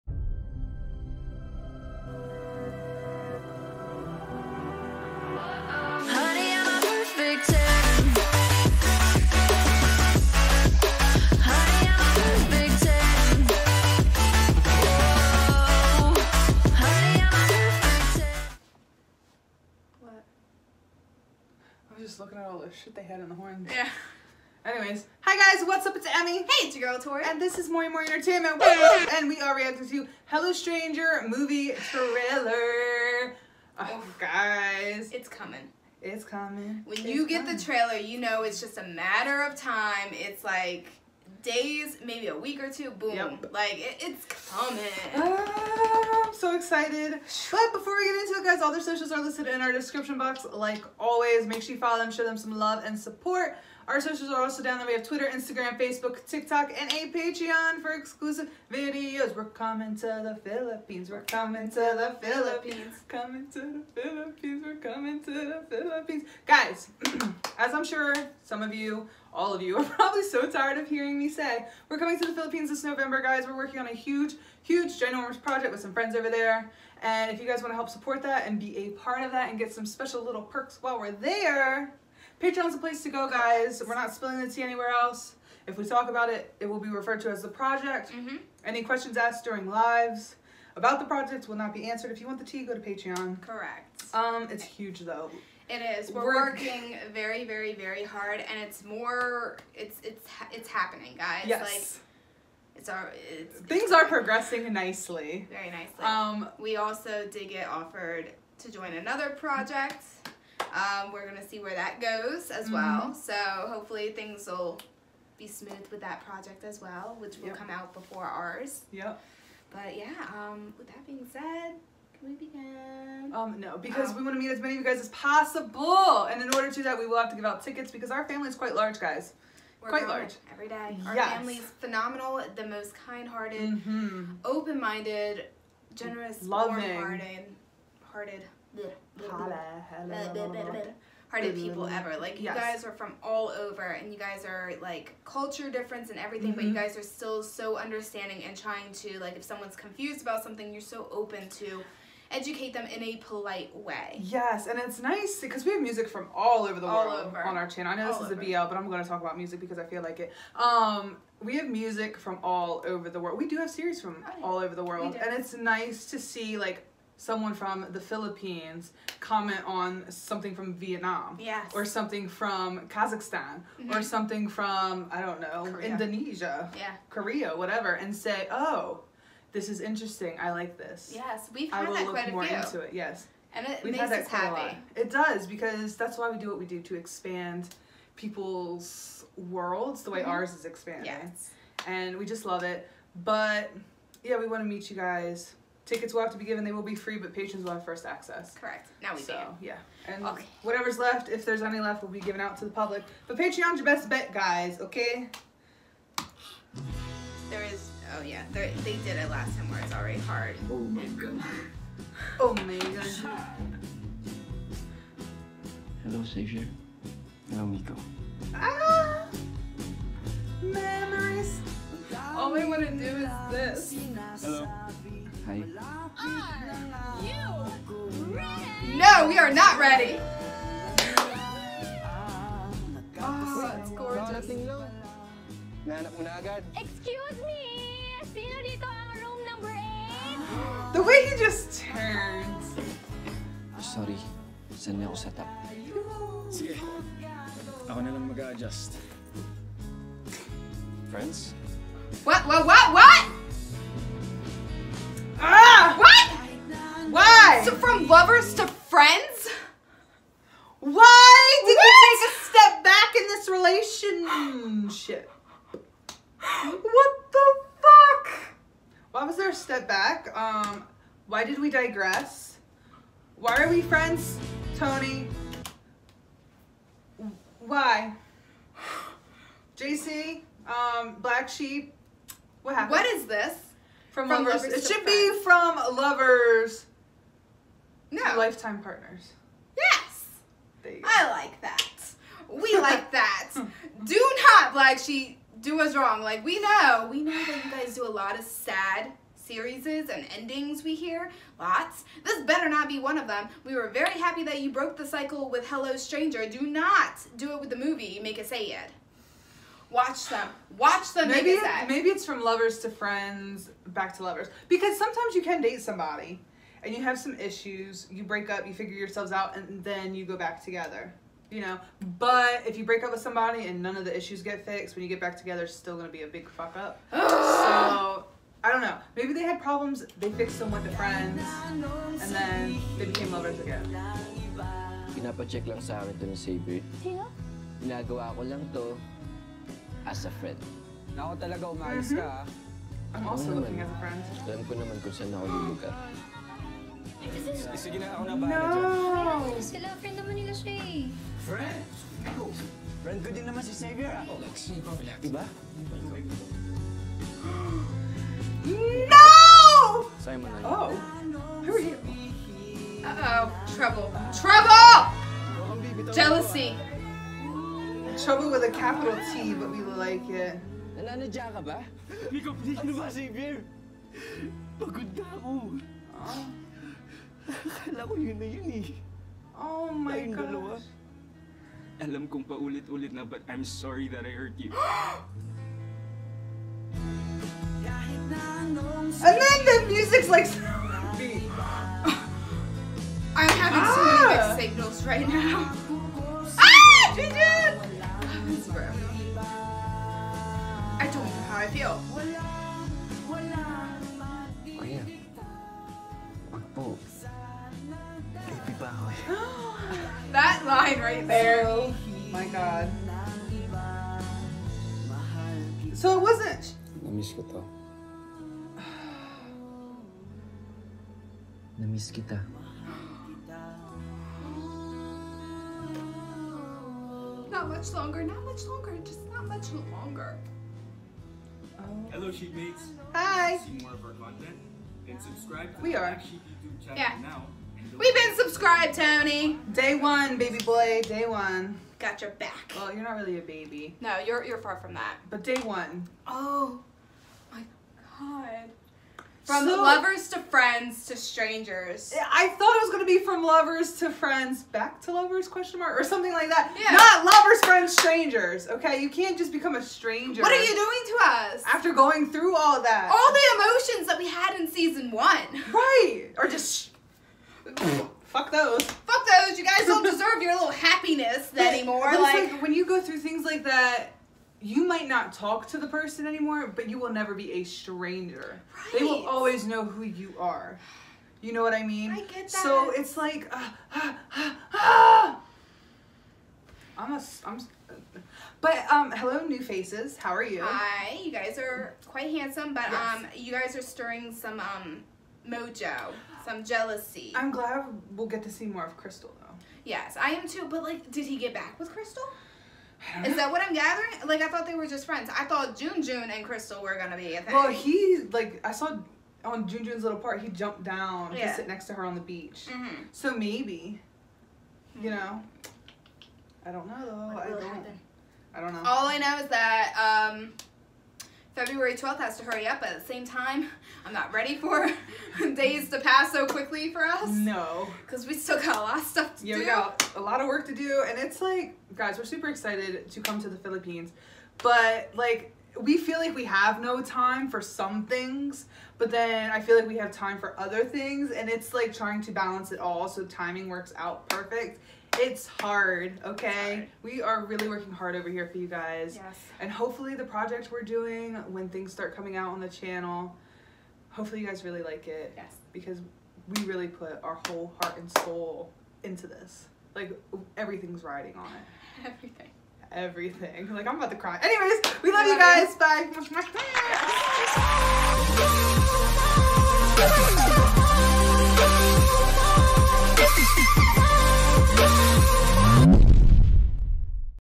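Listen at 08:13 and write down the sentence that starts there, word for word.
um, you guys are stirring some um, mojo, some jealousy.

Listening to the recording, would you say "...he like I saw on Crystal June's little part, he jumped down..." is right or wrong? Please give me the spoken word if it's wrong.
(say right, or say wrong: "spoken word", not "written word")
wrong: "June", not "Crystal".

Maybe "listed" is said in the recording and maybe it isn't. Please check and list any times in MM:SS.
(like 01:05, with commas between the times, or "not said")
00:49.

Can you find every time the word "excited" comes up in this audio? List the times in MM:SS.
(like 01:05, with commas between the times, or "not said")
00:46, 08:52.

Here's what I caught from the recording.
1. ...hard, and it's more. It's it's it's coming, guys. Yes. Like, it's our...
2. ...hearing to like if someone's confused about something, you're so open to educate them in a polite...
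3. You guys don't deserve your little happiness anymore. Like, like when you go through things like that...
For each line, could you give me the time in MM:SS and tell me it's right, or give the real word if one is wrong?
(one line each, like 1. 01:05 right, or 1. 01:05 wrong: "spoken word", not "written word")
1. 01:38 wrong: "happening", not "coming"
2. 02:28 wrong: "trying", not "hearing"
3. 07:49 right.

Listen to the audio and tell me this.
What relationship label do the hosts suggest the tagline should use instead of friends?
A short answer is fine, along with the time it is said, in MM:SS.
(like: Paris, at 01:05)
lifetime partners, at 04:48.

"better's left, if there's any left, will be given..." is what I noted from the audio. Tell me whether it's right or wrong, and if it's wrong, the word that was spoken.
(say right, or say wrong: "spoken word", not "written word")
wrong: "whatever", not "better".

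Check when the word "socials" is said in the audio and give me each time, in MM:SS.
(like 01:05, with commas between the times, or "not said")
00:48, 00:53.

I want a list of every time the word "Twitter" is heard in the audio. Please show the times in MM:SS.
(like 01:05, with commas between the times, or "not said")
00:55.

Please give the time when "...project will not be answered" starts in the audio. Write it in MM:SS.
01:31.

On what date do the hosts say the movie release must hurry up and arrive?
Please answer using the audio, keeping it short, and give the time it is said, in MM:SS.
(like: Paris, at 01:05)
February 12, at 08:41.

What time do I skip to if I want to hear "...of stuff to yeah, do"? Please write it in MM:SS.
08:48.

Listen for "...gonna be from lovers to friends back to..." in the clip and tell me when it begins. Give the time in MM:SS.
07:32.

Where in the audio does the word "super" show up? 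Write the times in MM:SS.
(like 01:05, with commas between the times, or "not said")
08:52.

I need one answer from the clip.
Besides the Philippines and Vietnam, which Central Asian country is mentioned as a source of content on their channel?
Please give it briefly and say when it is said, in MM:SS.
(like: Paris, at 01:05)
Kazakhstan, at 02:52.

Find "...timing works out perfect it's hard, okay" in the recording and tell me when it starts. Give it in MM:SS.
09:03.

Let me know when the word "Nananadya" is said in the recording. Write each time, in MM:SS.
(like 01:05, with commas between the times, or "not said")
06:10.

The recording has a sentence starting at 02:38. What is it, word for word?
a BL, but I'm going to talk about music because I feel like it.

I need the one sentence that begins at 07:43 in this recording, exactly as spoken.
All the emotions that we had in season one.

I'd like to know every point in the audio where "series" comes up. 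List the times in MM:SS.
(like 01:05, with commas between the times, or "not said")
02:43, 04:59.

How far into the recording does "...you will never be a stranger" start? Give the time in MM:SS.
07:56.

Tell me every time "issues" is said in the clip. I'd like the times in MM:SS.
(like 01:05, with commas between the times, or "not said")
05:17, 05:24.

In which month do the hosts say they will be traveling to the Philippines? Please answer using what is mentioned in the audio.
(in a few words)
November.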